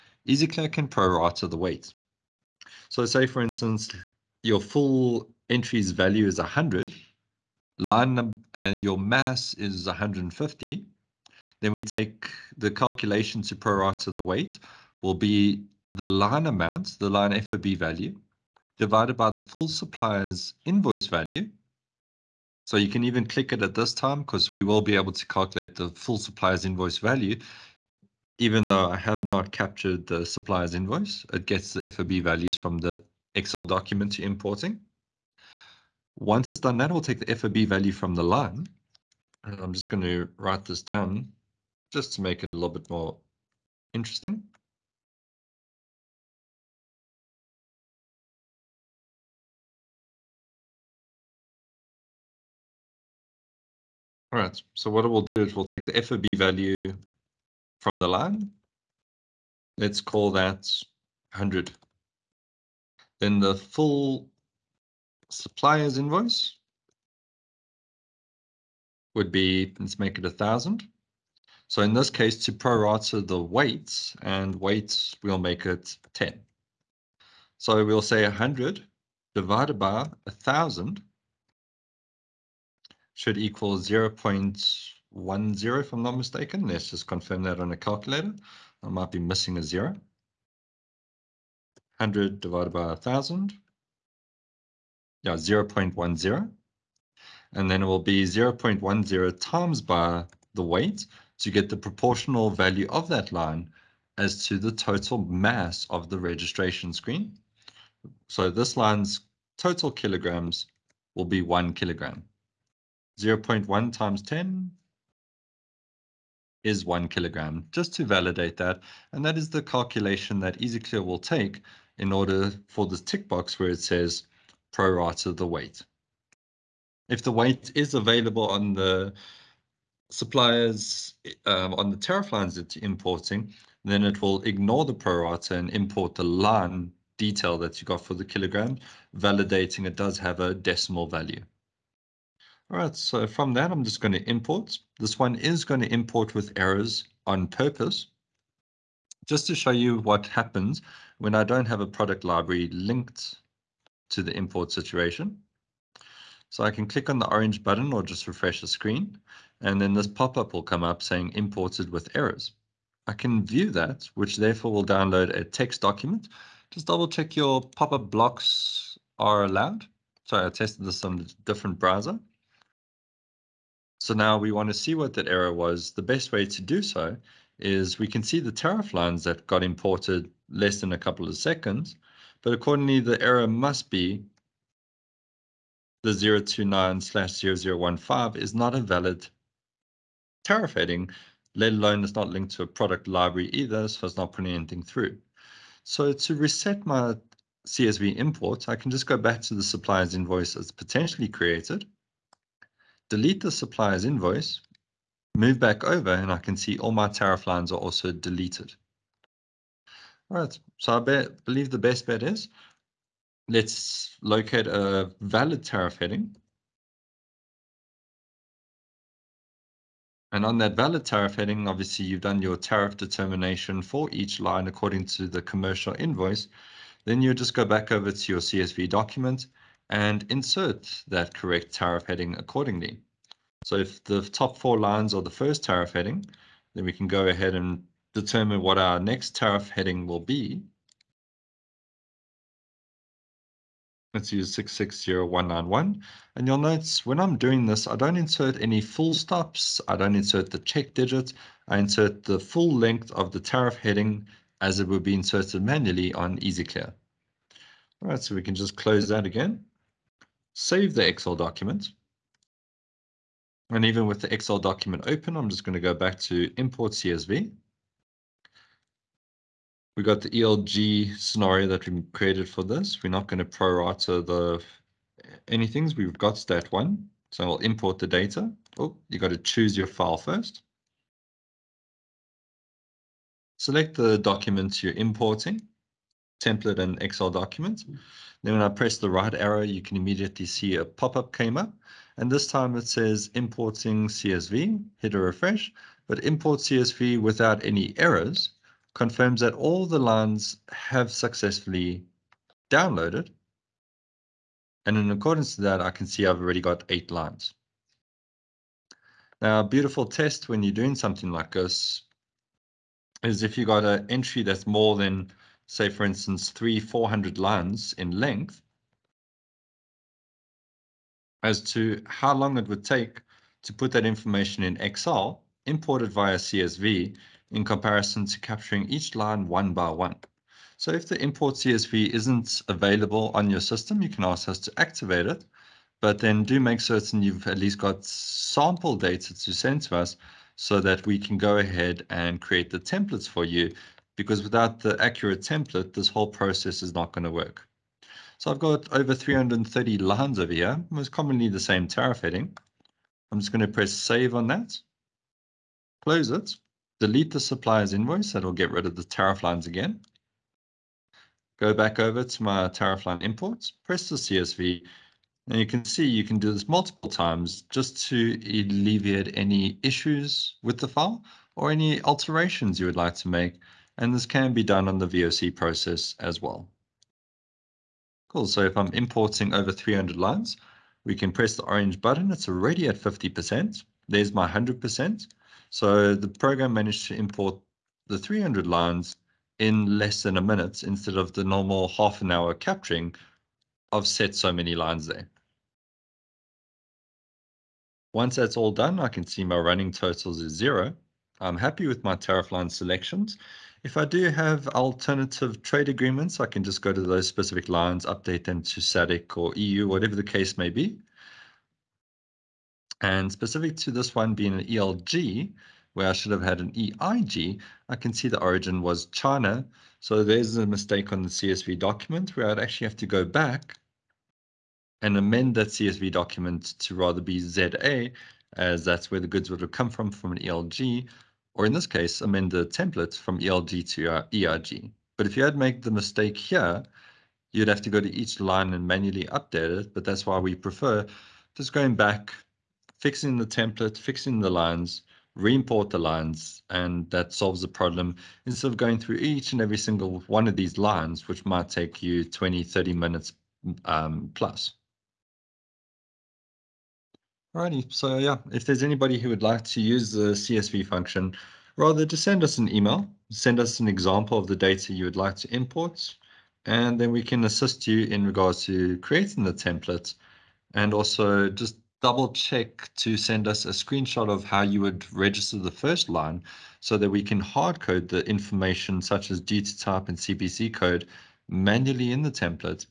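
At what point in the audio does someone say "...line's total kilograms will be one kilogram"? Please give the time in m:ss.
1:48.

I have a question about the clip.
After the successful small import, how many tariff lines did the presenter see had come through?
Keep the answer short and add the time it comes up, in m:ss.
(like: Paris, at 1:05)
8, at 5:06.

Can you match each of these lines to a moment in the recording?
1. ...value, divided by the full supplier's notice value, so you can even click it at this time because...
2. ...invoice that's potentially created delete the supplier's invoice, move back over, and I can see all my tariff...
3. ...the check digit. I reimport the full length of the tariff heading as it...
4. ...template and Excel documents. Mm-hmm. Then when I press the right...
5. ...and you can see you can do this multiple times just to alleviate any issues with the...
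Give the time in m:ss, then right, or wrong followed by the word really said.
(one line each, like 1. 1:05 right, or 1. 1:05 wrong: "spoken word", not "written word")
1. 0:17 wrong: "invoice", not "notice"
2. 3:20 right
3. 4:10 wrong: "insert", not "reimport"
4. 4:46 right
5. 6:05 right.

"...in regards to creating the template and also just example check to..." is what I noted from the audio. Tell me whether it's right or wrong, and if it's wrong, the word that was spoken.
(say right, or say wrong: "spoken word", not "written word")
wrong: "double", not "example".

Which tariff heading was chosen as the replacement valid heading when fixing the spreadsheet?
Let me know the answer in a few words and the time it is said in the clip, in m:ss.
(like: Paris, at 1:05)
660191, at 4:04.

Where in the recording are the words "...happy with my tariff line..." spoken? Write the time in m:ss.
6:41.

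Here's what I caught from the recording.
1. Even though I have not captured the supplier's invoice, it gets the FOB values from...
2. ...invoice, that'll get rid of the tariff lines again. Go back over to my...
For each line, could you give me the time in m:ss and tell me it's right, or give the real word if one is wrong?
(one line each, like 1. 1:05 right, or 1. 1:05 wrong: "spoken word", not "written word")
1. 0:28 right
2. 5:57 right.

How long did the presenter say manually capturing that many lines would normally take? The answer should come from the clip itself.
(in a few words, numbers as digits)
half an hour.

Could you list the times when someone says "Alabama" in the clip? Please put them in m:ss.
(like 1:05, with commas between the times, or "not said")
not said.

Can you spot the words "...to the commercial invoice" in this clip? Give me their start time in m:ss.
3:45.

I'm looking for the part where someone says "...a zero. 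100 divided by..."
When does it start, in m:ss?
1:29.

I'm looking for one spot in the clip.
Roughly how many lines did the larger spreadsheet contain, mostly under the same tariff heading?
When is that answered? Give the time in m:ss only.
5:48.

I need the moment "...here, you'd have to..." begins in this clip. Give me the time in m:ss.
7:16.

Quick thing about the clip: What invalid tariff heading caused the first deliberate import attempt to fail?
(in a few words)
029/0015.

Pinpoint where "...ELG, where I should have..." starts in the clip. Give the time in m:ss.
6:54.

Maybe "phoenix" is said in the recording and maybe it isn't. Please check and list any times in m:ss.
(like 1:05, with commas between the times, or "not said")
not said.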